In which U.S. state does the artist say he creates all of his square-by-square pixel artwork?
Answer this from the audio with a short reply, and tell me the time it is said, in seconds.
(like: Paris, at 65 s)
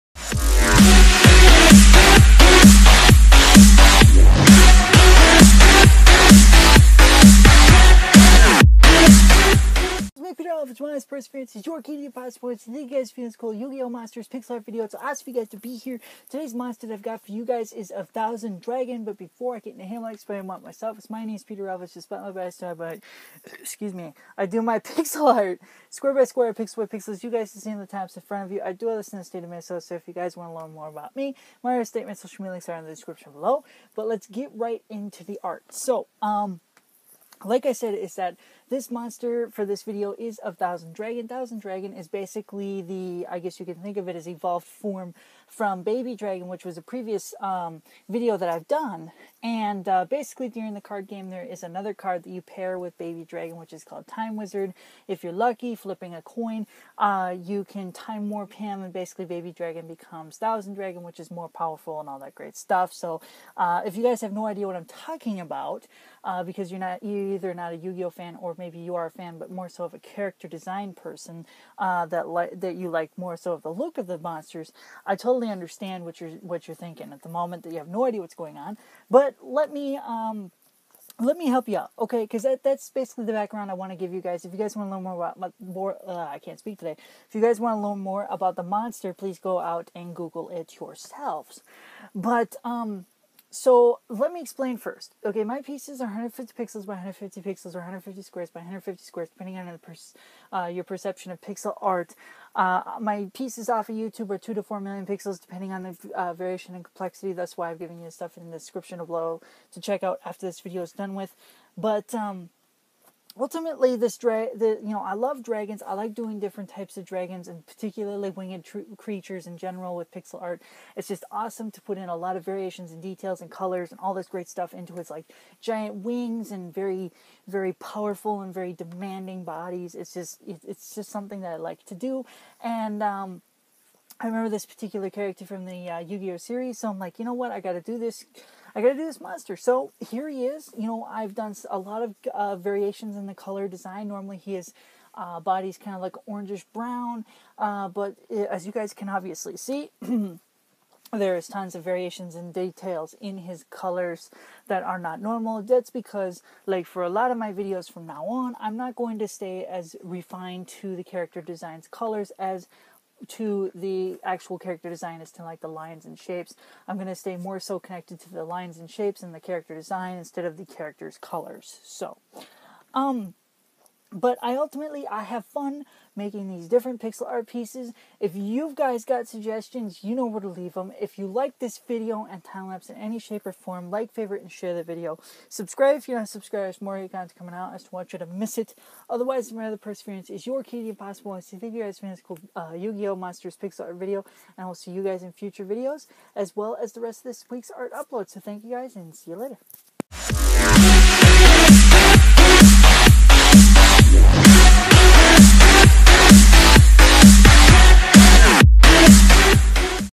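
Minnesota, at 29 s.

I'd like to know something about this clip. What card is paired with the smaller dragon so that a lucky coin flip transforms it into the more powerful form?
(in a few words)
Time Wizard.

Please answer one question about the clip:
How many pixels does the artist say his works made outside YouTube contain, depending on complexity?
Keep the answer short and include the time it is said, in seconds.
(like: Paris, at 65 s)
2 to 4 million, at 104 s.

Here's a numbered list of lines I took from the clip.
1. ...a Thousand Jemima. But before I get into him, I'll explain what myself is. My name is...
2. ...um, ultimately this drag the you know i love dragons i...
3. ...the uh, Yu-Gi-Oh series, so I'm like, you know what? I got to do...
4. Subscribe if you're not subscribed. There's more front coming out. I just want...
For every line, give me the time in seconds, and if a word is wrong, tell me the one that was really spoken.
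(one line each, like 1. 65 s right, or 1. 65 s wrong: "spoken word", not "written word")
1. 17 s wrong: "Dragon", not "Jemima"
2. 112 s right
3. 135 s right
4. 185 s wrong: "content", not "front".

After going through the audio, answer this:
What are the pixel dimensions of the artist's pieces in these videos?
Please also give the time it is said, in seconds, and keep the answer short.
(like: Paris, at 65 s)
150 by 150, at 96 s.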